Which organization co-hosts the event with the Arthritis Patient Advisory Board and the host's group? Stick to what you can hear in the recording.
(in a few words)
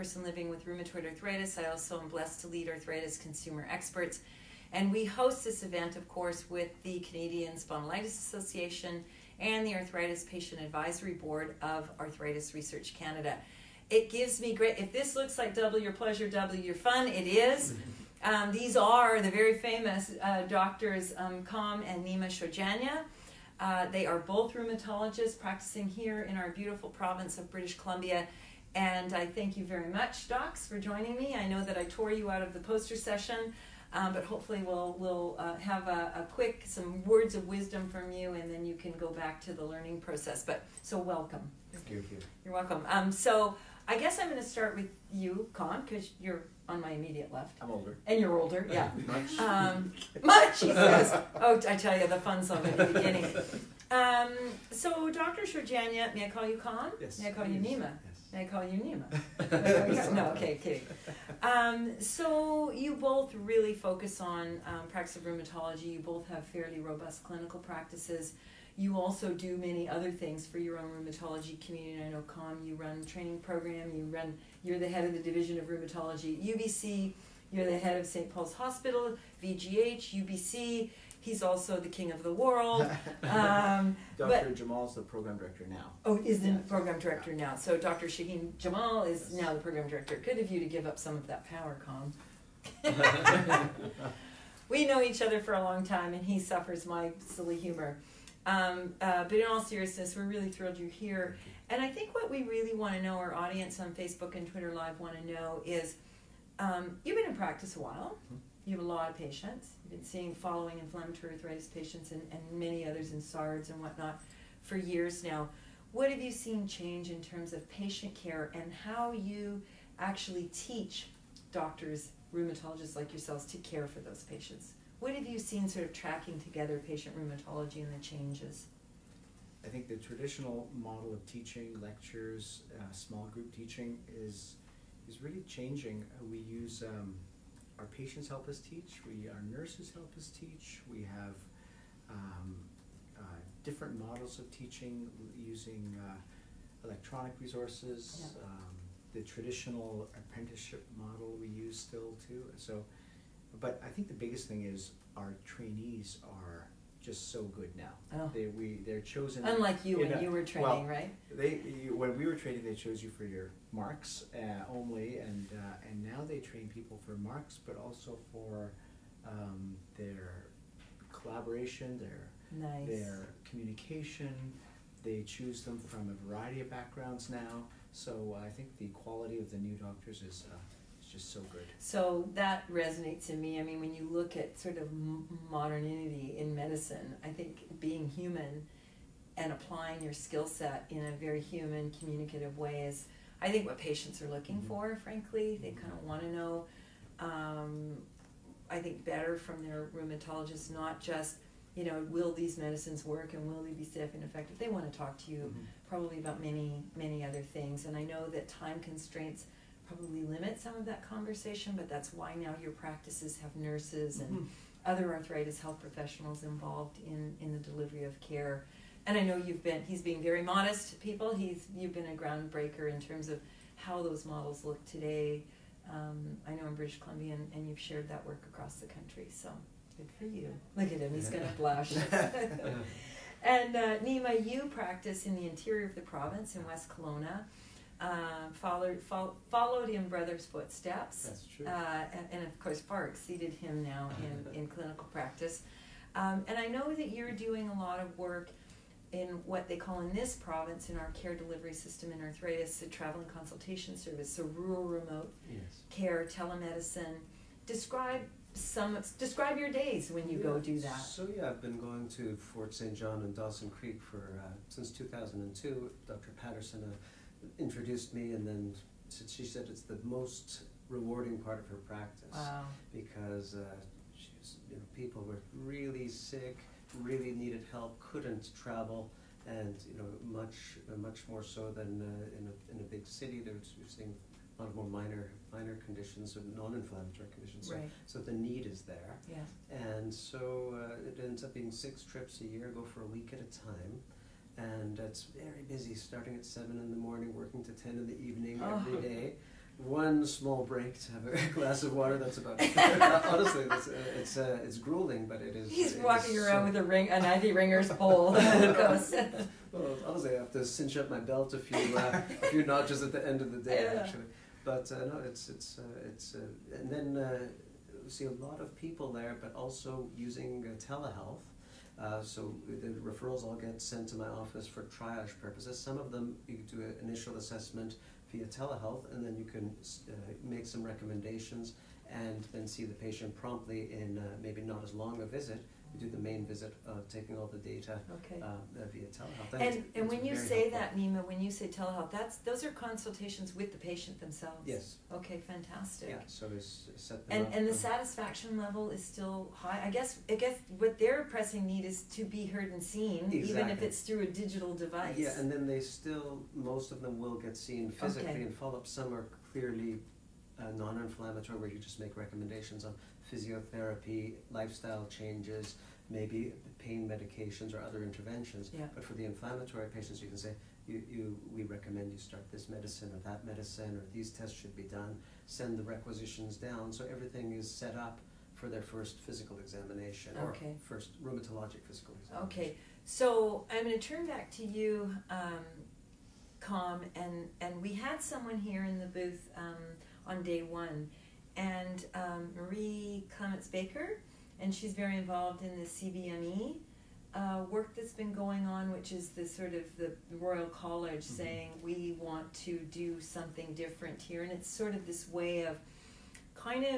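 Canadian Spondylitis Association.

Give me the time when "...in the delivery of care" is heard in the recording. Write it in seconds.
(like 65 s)
217 s.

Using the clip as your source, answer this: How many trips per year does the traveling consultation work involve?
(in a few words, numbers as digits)
6.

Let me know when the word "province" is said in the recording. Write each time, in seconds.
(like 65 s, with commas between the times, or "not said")
26 s, 236 s, 250 s.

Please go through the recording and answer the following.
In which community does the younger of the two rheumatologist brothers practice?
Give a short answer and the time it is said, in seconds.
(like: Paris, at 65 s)
West Kelowna, at 236 s.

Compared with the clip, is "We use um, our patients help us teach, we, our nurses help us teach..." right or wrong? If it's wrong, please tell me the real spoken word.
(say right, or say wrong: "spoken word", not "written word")
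right.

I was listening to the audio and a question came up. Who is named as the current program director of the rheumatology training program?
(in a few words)
Dr. Shaheen Jamal.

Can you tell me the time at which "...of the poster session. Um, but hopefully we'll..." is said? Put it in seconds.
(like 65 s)
32 s.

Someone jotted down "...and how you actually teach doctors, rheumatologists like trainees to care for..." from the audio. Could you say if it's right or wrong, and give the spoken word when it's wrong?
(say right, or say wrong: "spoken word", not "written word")
wrong: "yourselves", not "trainees".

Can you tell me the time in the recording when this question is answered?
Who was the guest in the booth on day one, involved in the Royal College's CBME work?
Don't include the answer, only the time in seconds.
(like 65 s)
392 s.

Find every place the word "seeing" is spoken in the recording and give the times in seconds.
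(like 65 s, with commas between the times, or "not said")
110 s, 283 s.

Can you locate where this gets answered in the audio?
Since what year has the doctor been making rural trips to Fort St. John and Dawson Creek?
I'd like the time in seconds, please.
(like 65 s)
264 s.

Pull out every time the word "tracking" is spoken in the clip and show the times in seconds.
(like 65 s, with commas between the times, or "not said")
125 s.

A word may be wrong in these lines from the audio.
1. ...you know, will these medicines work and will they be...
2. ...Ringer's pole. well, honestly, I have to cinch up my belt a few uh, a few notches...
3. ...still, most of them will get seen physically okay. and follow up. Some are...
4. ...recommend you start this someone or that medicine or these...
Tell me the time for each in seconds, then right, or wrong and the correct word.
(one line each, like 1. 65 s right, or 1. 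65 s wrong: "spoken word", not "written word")
1. 201 s right
2. 307 s right
3. 355 s right
4. 371 s wrong: "medicine", not "someone".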